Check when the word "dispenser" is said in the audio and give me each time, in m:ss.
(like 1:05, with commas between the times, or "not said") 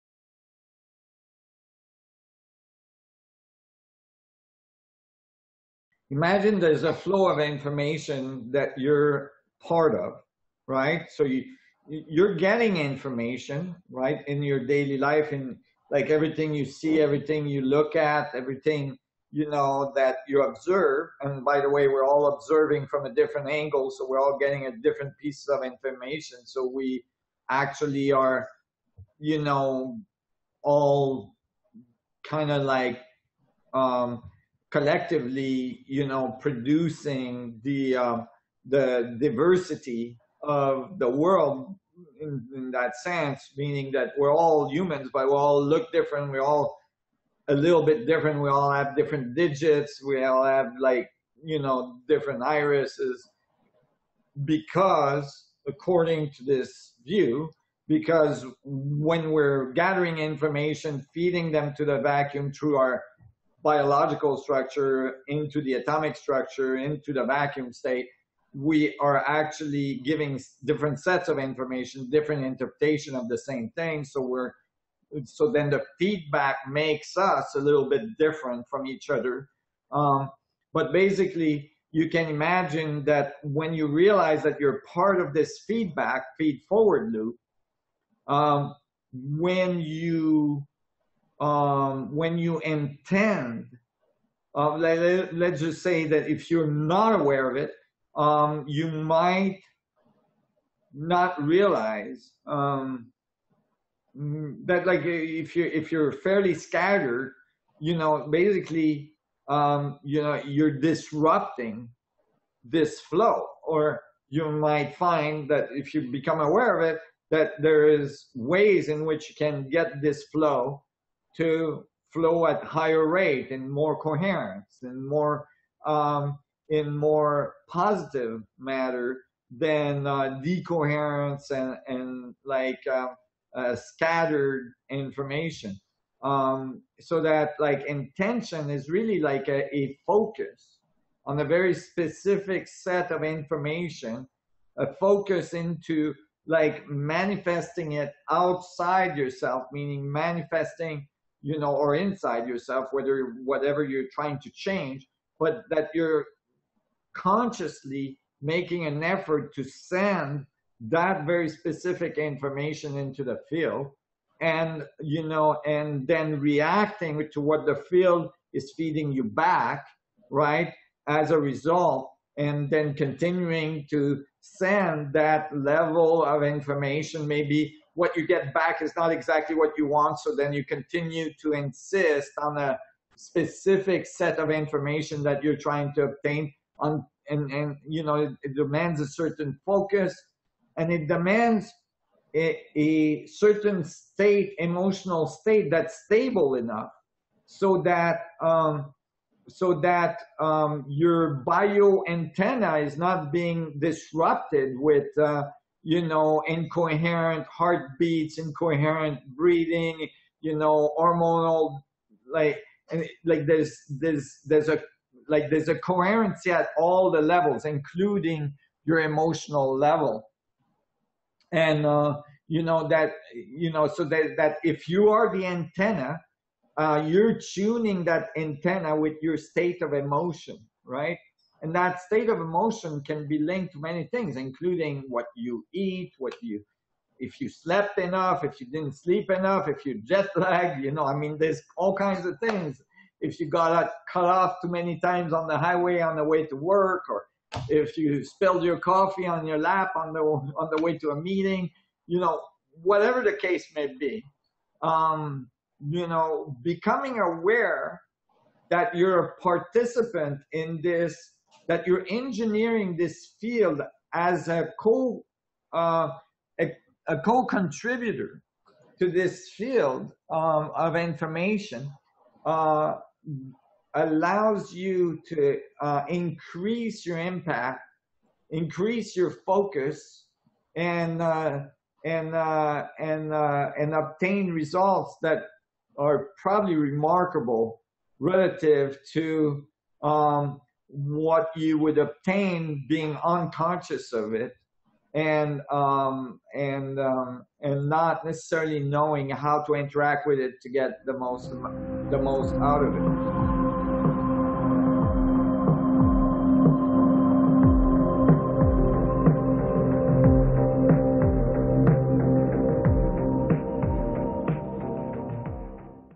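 not said.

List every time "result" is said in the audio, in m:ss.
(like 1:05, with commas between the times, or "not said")
2:51, 4:44.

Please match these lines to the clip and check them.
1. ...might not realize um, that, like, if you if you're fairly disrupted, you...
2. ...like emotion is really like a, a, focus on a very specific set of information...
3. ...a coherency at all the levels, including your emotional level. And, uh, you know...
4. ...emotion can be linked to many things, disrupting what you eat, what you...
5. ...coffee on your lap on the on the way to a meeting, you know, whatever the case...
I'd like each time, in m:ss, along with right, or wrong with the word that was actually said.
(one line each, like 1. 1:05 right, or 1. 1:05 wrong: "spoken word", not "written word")
1. 1:38 wrong: "scattered", not "disrupted"
2. 2:17 wrong: "intention", not "emotion"
3. 3:35 right
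4. 3:52 wrong: "including", not "disrupting"
5. 4:08 right.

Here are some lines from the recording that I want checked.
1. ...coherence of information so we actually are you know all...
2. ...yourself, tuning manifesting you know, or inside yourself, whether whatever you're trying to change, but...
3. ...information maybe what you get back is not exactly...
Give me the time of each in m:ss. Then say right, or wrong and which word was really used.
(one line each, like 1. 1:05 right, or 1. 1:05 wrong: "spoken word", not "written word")
1. 0:25 wrong: "piece", not "coherence"
2. 2:29 wrong: "meaning", not "tuning"
3. 2:56 right.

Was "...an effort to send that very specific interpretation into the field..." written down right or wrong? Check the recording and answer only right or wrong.
wrong.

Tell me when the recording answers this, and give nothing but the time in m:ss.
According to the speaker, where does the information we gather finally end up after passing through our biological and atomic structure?
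1:07.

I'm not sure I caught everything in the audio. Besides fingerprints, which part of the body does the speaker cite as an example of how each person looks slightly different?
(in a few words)
irises.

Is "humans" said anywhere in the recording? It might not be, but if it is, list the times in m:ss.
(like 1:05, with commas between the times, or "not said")
0:44.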